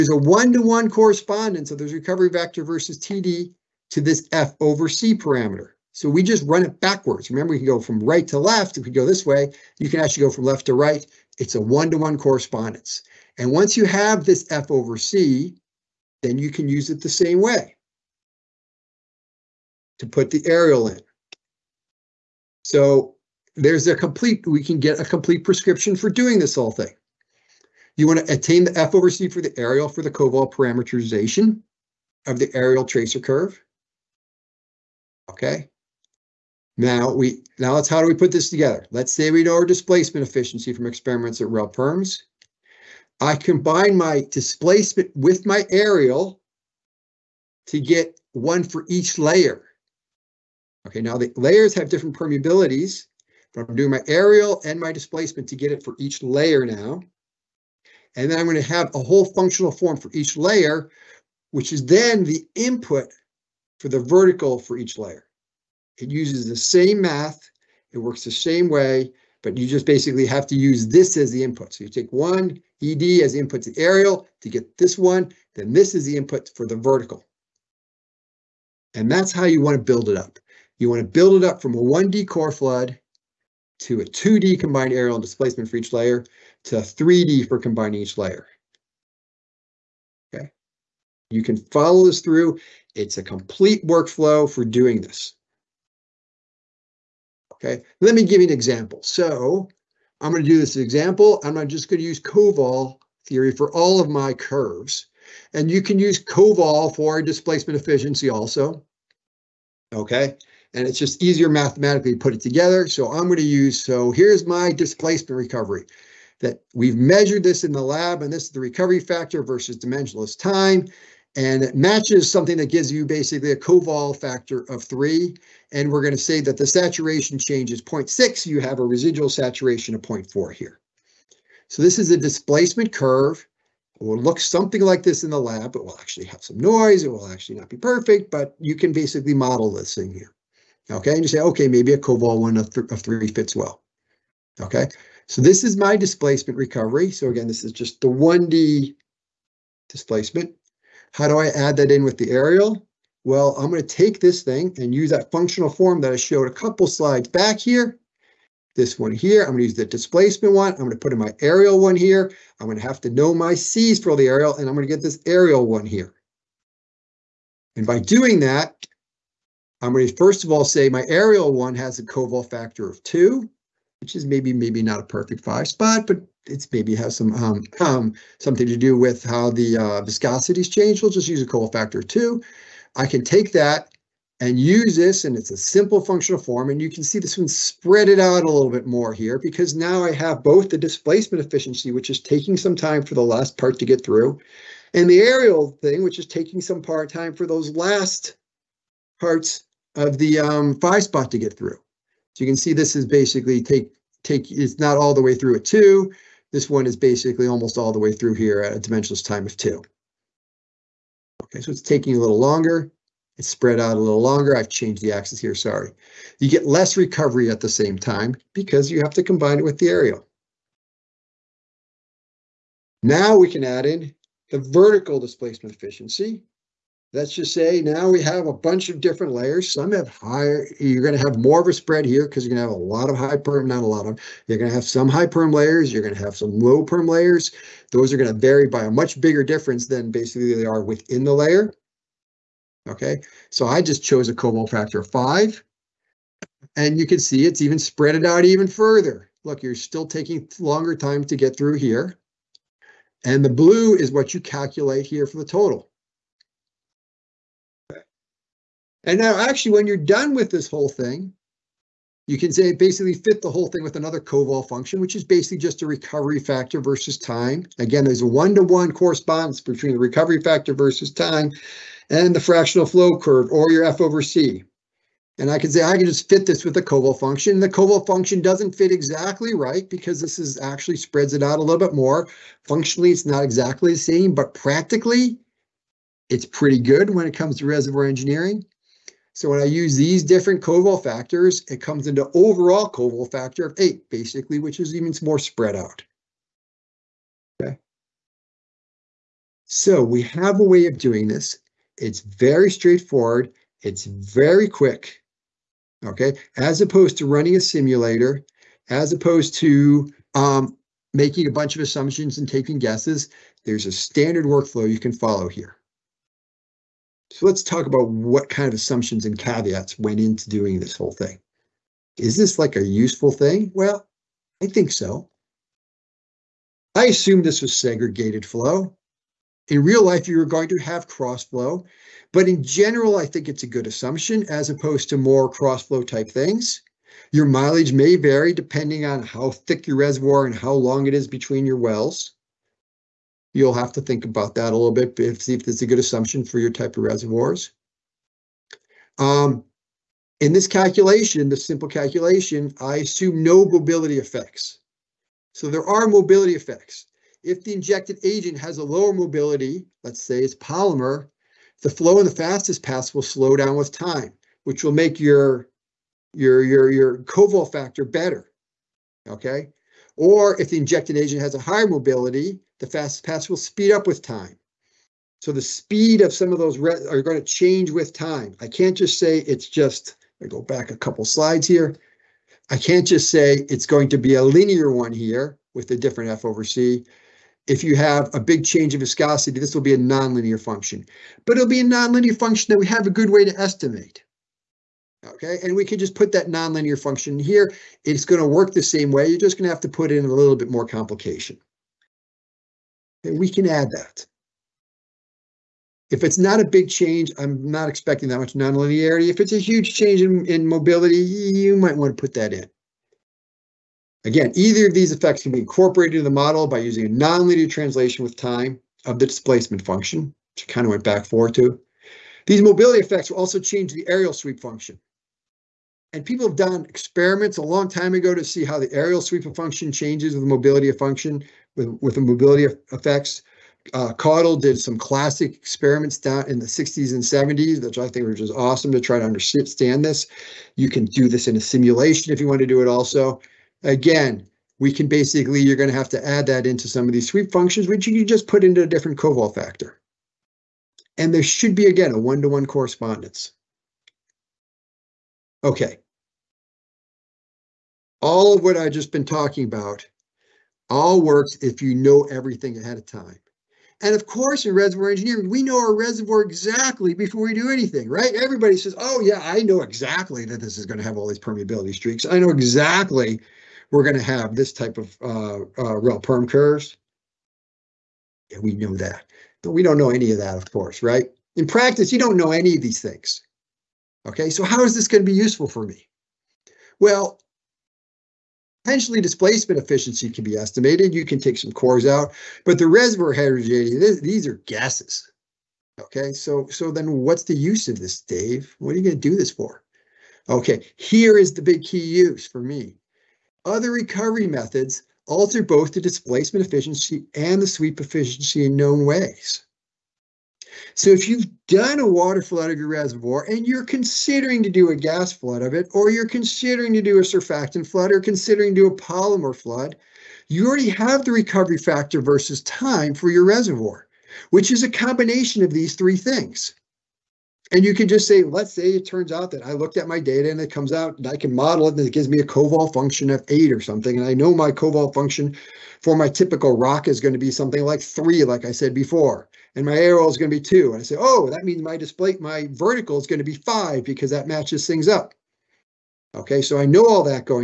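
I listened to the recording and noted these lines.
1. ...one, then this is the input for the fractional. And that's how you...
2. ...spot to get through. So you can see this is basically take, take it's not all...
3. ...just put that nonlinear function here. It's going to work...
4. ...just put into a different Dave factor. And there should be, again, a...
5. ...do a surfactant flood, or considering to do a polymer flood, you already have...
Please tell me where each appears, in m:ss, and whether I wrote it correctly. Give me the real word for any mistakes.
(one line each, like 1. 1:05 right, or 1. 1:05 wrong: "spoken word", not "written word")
1. 1:14 wrong: "vertical", not "fractional"
2. 3:21 right
3. 6:35 right
4. 7:28 wrong: "Koval", not "Dave"
5. 8:37 right.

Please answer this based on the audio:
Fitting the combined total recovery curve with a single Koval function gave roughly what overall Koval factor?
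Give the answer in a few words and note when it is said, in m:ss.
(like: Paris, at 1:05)
8, at 4:52.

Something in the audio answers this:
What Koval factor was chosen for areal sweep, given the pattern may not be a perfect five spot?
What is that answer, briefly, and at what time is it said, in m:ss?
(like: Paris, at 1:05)
2, at 2:52.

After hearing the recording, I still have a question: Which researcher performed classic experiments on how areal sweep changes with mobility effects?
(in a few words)
Caudle.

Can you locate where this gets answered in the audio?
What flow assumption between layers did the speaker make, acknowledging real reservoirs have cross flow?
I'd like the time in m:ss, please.
5:27.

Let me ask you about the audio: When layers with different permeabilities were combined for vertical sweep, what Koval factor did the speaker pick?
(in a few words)
5.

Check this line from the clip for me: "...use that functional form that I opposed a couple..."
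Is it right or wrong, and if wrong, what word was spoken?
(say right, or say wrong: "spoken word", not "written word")
wrong: "showed", not "opposed".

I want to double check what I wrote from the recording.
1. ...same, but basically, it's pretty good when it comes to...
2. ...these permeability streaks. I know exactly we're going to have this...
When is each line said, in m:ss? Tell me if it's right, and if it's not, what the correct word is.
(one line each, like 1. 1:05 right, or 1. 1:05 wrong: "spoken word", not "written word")
1. 4:43 wrong: "practically", not "basically"
2. 7:51 right.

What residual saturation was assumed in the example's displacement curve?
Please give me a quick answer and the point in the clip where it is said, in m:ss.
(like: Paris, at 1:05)
0.4, at 2:10.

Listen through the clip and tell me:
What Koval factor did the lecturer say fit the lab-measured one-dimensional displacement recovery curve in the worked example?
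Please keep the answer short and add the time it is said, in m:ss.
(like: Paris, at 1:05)
3, at 2:03.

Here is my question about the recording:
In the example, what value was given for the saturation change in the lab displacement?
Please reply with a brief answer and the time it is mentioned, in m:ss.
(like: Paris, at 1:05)
0.6, at 2:07.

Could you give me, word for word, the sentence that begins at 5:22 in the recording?
Is this like a useful thing?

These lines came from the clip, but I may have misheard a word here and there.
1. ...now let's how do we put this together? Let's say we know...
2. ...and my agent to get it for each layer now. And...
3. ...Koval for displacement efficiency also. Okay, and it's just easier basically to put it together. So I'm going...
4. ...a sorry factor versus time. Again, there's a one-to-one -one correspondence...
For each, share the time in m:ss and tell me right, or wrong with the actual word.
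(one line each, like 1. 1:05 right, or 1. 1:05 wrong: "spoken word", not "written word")
1. 0:37 right
2. 0:54 wrong: "displacement", not "agent"
3. 1:46 wrong: "mathematically", not "basically"
4. 4:25 wrong: "recovery", not "sorry".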